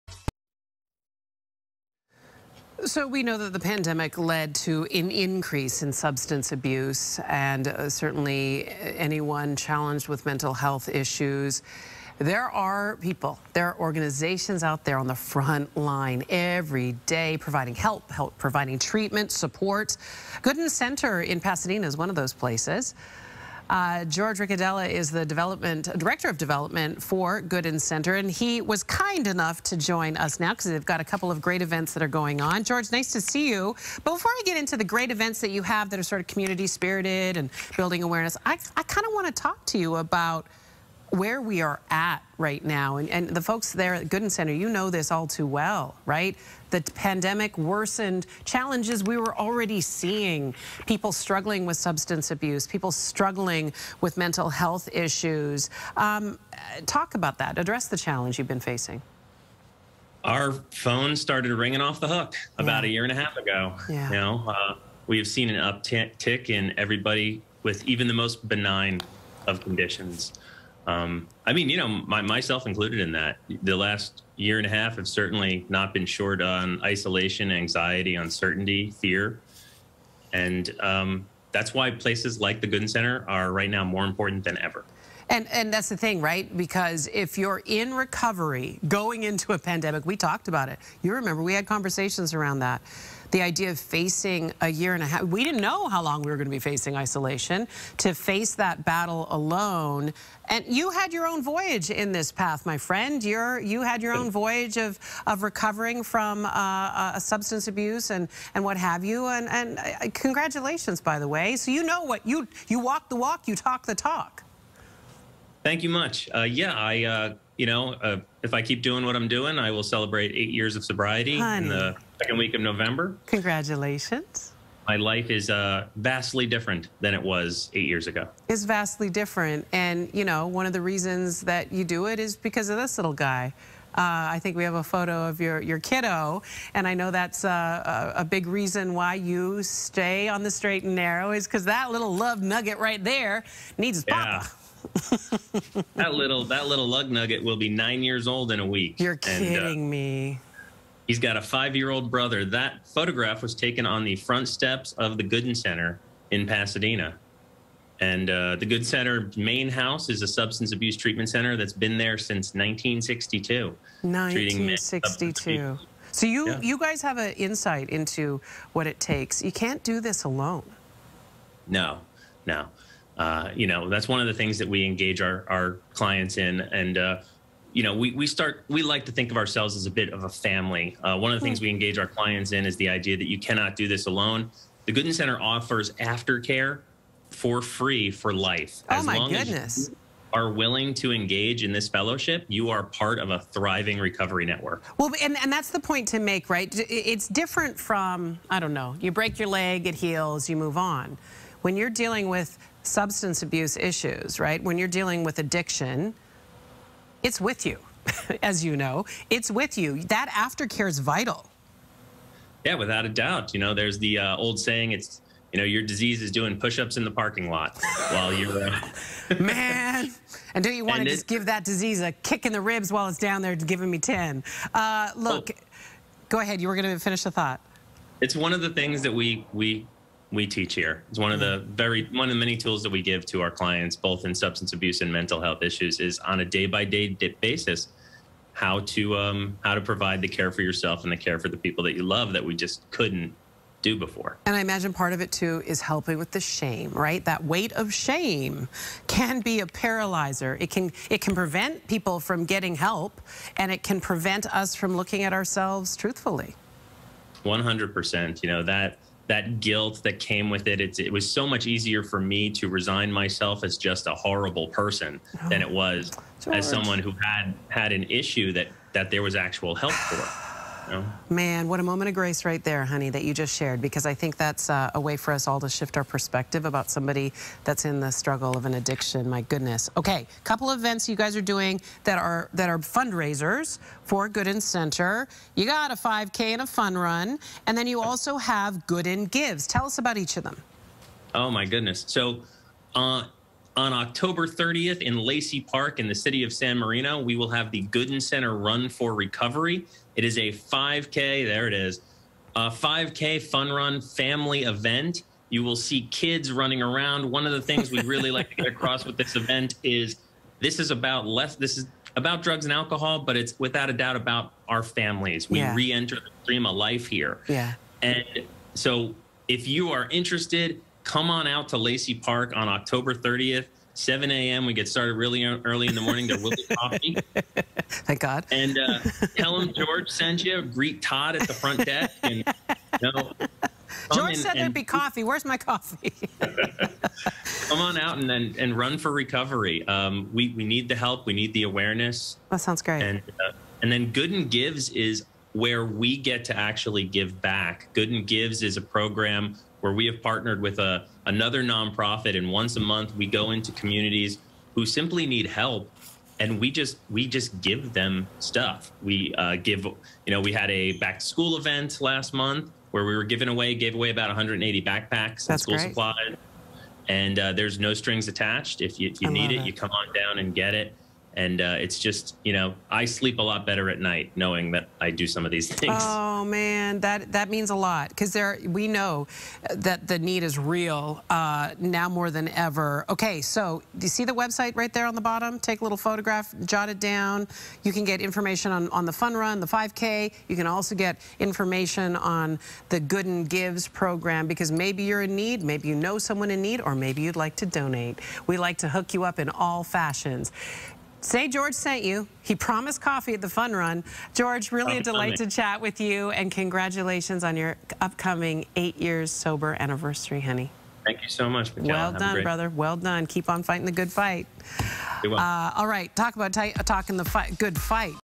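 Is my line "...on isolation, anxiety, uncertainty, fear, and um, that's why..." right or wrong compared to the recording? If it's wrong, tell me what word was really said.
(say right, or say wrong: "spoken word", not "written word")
right.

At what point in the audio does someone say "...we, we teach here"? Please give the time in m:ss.
3:49.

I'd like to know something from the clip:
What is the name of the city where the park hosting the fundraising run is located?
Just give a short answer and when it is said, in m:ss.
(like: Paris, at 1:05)
San Marino, at 4:56.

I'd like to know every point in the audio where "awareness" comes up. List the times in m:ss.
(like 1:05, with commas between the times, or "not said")
0:38, 5:41.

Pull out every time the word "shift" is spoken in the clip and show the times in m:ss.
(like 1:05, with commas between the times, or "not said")
4:35.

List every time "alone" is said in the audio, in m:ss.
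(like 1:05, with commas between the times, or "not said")
1:39, 2:50, 3:04.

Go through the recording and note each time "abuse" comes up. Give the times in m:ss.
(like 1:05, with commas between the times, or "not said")
0:06, 0:52, 1:47, 2:40, 3:23, 3:54.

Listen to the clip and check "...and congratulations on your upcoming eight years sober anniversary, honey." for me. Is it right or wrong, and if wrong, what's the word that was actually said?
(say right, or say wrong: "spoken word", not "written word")
right.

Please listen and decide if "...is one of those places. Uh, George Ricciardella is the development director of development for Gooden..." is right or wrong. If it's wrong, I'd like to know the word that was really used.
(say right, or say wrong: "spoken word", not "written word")
right.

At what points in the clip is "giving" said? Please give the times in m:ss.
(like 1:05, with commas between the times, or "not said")
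3:43, 6:03.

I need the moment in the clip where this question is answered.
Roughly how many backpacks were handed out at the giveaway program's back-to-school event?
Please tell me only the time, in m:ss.
6:04.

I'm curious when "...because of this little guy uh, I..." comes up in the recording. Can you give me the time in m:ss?
2:12.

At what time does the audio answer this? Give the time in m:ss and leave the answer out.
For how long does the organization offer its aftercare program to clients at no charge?
3:08.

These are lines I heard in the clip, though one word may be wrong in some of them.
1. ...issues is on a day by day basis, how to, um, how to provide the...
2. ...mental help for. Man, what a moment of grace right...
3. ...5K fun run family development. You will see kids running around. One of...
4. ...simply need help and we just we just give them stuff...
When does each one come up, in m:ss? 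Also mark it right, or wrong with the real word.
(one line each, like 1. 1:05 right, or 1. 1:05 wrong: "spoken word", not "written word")
1. 3:55 right
2. 4:29 wrong: "actual", not "mental"
3. 5:02 wrong: "event", not "development"
4. 5:54 right.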